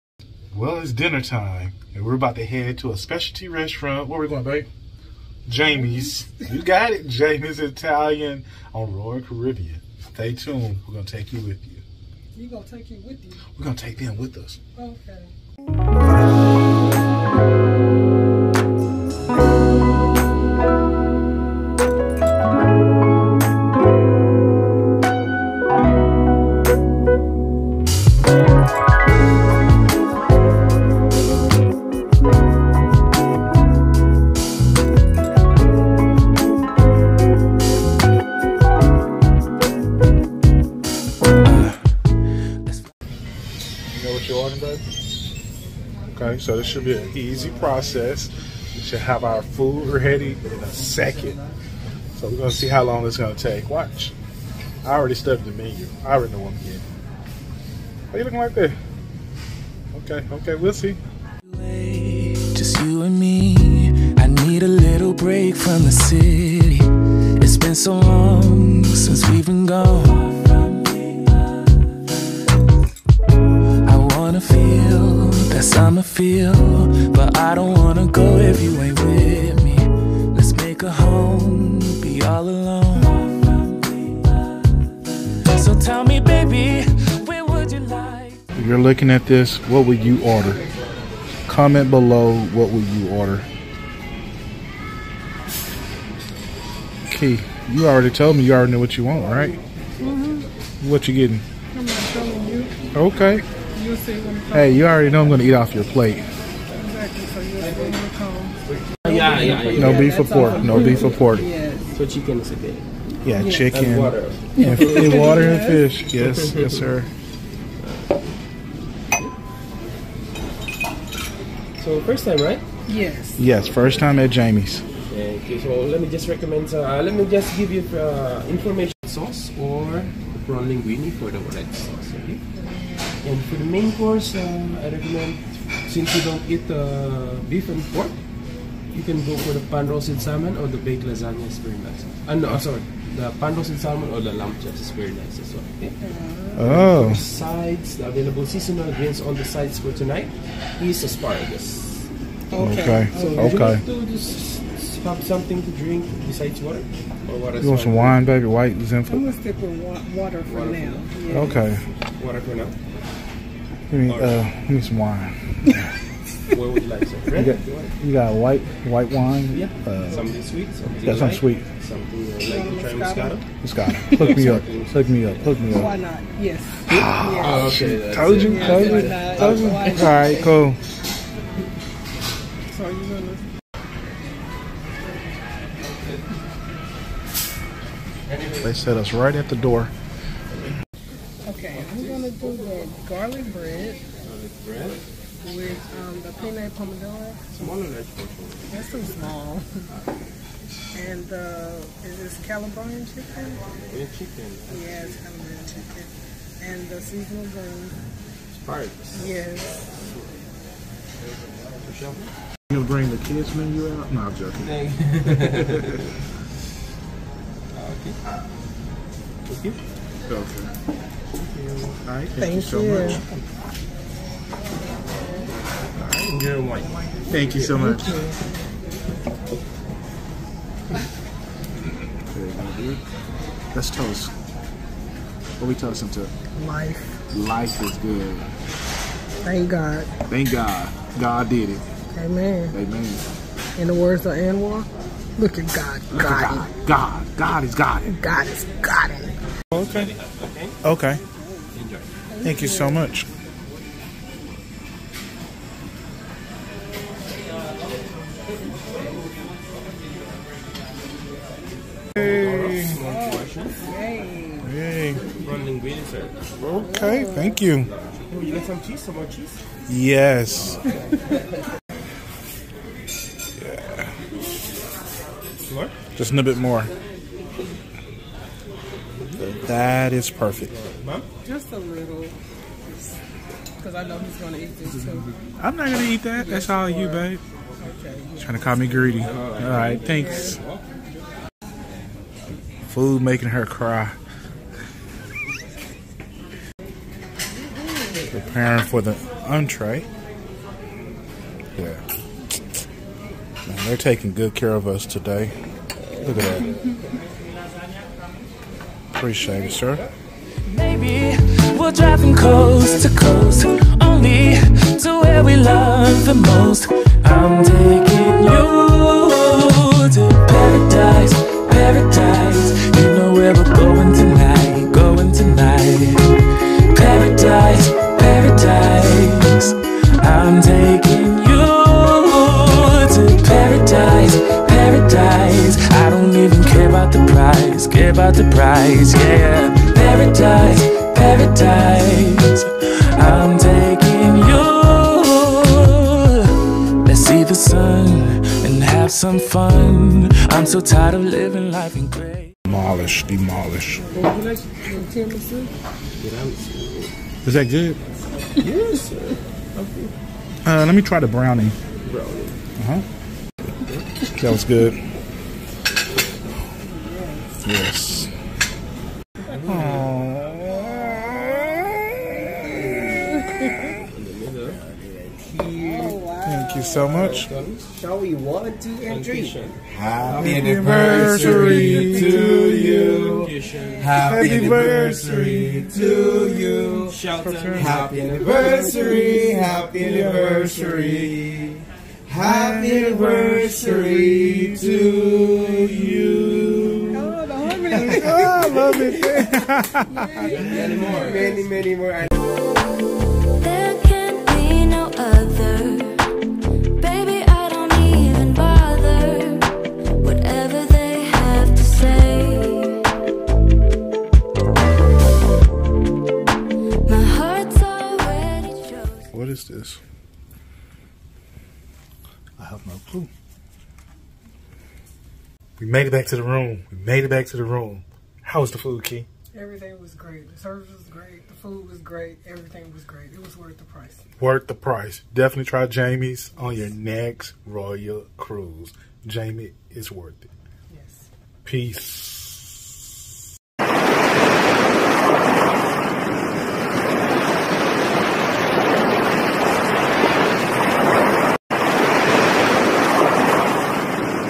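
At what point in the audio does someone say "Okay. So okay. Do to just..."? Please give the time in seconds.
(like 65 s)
153 s.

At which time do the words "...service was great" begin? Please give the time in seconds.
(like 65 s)
430 s.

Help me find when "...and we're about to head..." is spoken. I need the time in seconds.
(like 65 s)
1 s.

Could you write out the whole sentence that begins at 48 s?
We should have our food ready in a second.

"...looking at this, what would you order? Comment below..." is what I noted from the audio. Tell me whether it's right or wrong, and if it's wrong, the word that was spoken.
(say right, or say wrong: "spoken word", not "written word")
right.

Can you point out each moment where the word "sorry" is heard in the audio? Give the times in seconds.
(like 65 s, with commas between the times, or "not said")
142 s.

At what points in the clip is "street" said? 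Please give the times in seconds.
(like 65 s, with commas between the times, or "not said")
not said.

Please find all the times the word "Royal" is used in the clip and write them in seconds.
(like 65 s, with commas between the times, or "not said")
8 s, 437 s.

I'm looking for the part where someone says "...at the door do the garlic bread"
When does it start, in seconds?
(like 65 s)
189 s.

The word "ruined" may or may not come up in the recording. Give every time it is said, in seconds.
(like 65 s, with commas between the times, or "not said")
not said.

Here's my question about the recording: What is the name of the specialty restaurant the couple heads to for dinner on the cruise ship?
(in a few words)
Jamie's Italian.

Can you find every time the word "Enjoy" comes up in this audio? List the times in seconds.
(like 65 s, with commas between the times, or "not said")
251 s.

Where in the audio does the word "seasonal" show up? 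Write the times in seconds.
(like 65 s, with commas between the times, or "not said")
148 s, 207 s.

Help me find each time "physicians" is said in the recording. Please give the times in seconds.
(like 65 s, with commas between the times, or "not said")
not said.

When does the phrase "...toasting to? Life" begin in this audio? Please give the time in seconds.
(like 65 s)
235 s.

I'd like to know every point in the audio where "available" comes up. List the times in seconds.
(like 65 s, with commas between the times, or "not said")
148 s.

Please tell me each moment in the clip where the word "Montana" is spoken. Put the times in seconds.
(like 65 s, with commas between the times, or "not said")
not said.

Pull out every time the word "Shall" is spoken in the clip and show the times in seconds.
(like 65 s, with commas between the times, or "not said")
377 s.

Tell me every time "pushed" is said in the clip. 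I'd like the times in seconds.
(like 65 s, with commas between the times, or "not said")
not said.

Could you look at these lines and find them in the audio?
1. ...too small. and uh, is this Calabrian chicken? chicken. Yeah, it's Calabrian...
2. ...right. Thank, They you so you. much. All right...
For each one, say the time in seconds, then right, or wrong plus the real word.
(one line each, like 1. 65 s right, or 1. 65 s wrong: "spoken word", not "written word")
1. 198 s right
2. 222 s wrong: "Thank", not "They".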